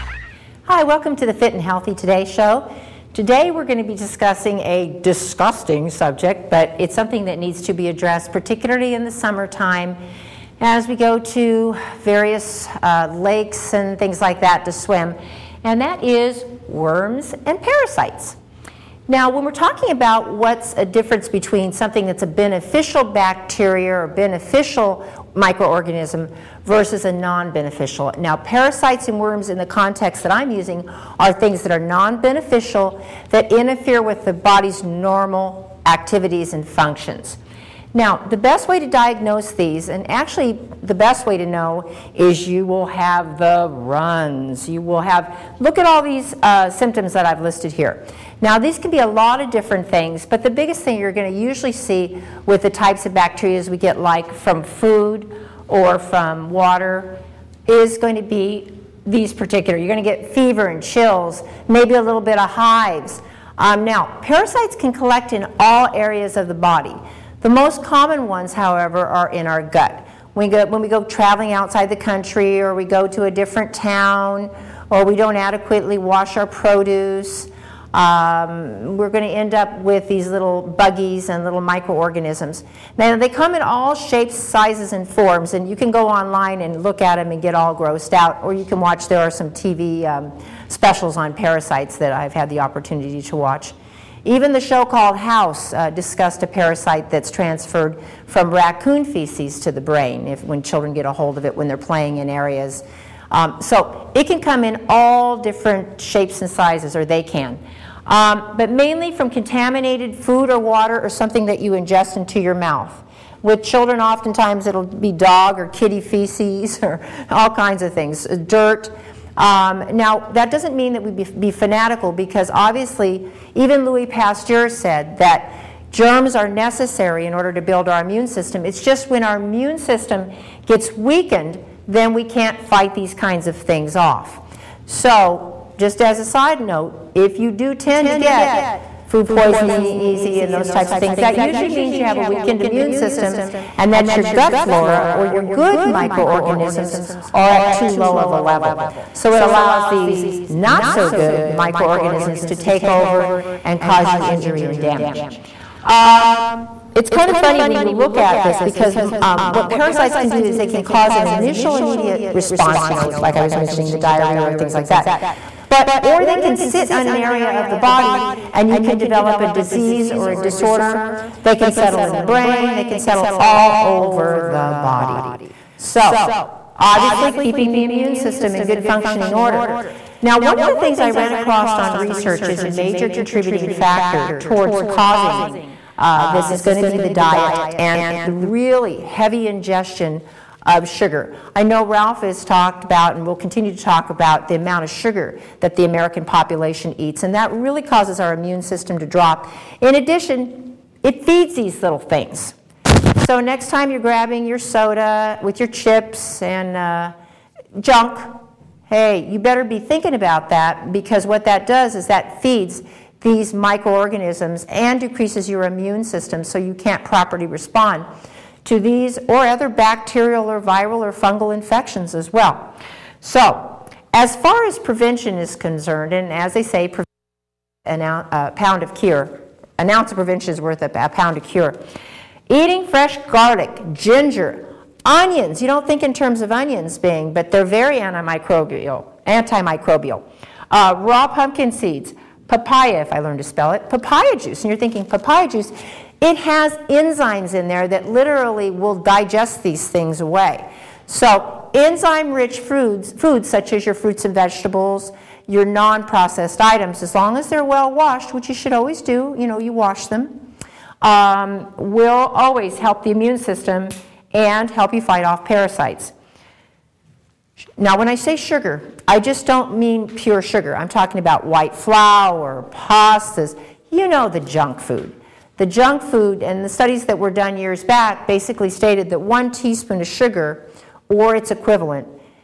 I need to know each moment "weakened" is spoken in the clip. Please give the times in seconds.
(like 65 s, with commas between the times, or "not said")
130 s, 142 s.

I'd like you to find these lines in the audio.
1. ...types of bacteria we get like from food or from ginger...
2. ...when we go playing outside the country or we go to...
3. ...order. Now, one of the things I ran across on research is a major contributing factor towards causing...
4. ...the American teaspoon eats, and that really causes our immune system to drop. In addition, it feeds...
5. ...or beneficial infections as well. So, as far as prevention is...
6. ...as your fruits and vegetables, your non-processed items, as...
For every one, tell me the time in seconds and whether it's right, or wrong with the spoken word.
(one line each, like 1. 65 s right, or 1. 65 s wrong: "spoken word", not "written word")
1. 52 s wrong: "water", not "ginger"
2. 70 s wrong: "traveling", not "playing"
3. 179 s right
4. 195 s wrong: "population", not "teaspoon"
5. 220 s wrong: "fungal", not "beneficial"
6. 253 s right.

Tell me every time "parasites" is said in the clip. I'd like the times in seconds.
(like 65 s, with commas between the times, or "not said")
17 s, 28 s, 64 s, 91 s, 96 s, 159 s, 265 s.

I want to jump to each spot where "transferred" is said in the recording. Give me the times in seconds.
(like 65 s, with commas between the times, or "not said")
97 s.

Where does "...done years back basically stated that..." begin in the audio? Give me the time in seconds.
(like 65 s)
277 s.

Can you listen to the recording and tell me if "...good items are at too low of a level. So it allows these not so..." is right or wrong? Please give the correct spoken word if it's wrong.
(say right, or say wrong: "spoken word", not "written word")
wrong: "microorganisms", not "items".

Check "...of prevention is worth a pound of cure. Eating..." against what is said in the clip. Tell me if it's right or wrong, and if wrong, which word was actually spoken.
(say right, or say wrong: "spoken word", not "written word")
right.